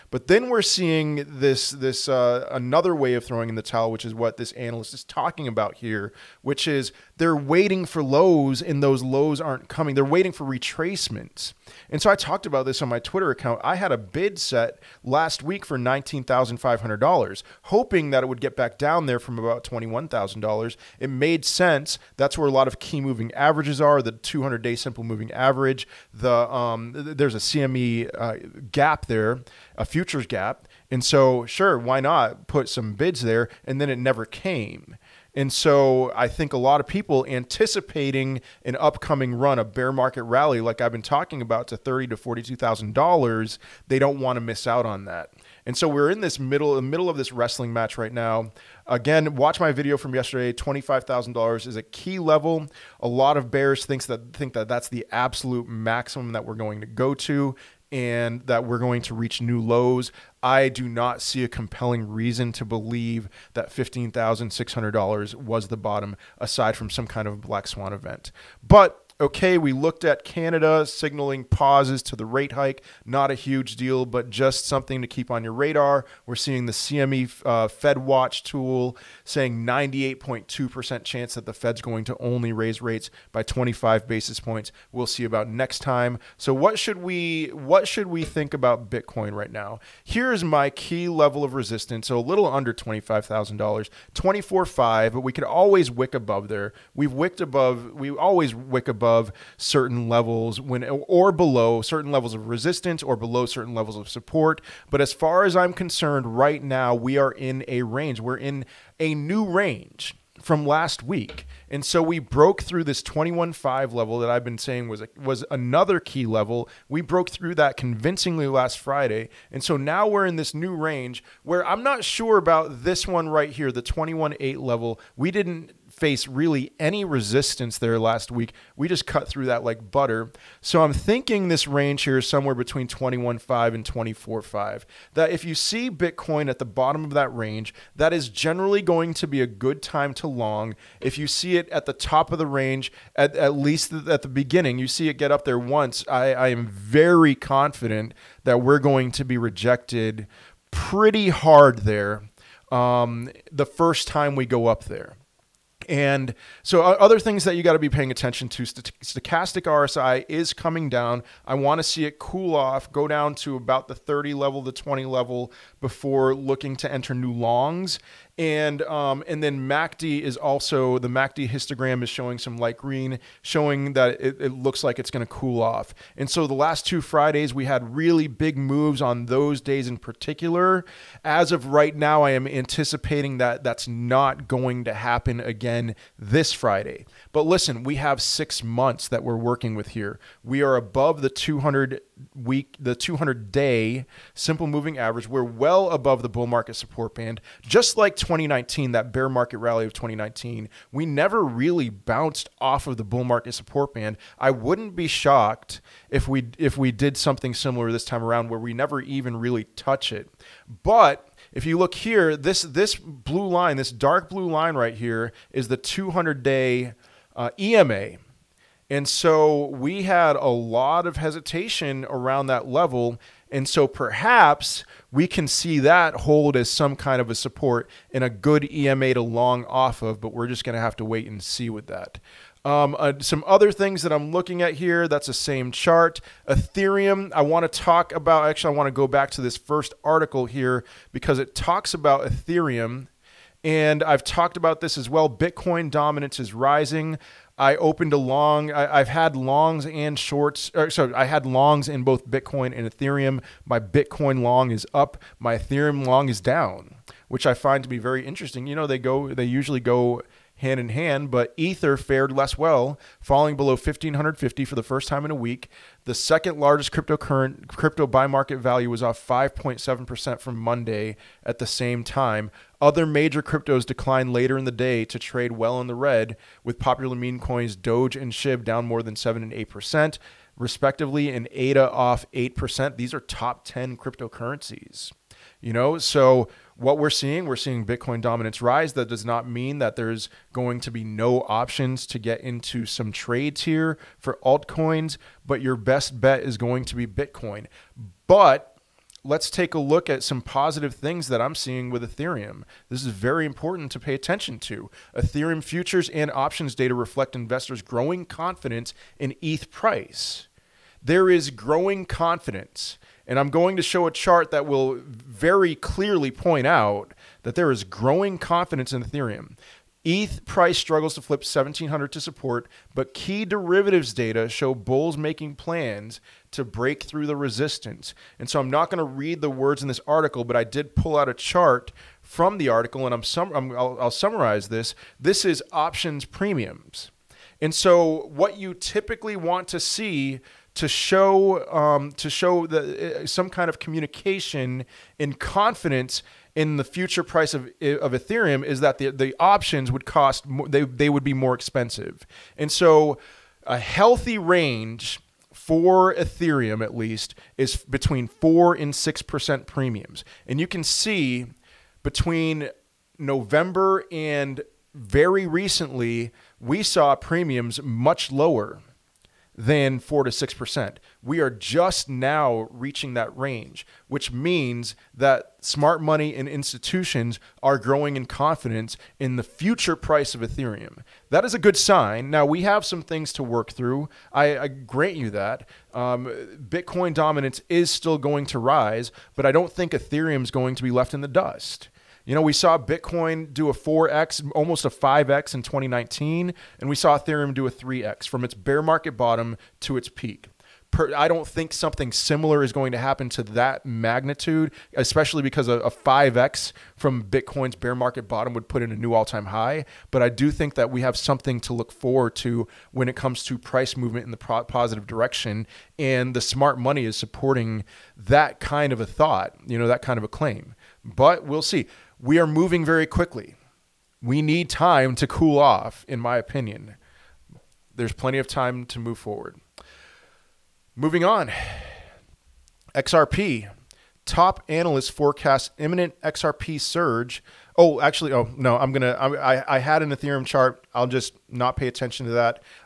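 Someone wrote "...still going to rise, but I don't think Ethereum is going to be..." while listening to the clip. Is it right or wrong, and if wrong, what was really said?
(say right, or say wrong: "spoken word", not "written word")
right.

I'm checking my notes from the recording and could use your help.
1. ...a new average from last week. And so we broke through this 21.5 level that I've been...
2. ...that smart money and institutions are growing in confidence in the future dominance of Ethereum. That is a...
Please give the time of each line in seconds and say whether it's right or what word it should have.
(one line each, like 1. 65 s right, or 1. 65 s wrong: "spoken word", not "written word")
1. 109 s wrong: "range", not "average"
2. 375 s wrong: "price", not "dominance".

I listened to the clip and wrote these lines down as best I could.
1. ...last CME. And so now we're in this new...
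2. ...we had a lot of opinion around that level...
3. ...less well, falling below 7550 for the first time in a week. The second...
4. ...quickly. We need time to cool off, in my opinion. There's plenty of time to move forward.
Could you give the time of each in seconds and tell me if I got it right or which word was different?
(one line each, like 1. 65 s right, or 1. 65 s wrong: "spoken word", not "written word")
1. 118 s wrong: "Friday", not "CME"
2. 219 s wrong: "hesitation", not "opinion"
3. 262 s wrong: "1550", not "7550"
4. 423 s right.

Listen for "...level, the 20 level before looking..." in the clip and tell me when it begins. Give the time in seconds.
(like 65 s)
164 s.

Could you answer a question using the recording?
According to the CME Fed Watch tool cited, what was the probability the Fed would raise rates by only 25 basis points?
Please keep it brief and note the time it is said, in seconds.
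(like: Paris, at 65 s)
98.2%, at 79 s.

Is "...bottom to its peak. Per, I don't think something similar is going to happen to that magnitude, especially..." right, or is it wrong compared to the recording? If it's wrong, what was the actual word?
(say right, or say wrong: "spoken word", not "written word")
right.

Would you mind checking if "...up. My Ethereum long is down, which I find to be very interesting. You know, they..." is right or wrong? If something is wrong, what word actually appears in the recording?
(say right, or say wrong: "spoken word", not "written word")
right.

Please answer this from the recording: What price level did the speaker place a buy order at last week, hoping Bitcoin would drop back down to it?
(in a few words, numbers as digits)
$19,500.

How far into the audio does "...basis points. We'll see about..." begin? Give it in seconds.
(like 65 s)
84 s.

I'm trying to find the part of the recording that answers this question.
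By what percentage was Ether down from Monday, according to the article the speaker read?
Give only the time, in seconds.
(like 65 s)
269 s.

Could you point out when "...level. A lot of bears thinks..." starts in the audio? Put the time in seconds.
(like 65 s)
52 s.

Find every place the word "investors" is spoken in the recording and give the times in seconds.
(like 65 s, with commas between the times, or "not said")
307 s.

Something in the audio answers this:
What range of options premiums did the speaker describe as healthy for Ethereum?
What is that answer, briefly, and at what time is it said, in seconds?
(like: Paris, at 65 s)
4 to 6 percent, at 358 s.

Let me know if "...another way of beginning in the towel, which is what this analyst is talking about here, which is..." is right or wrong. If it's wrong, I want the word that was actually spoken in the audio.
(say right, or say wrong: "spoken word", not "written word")
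wrong: "throwing", not "beginning".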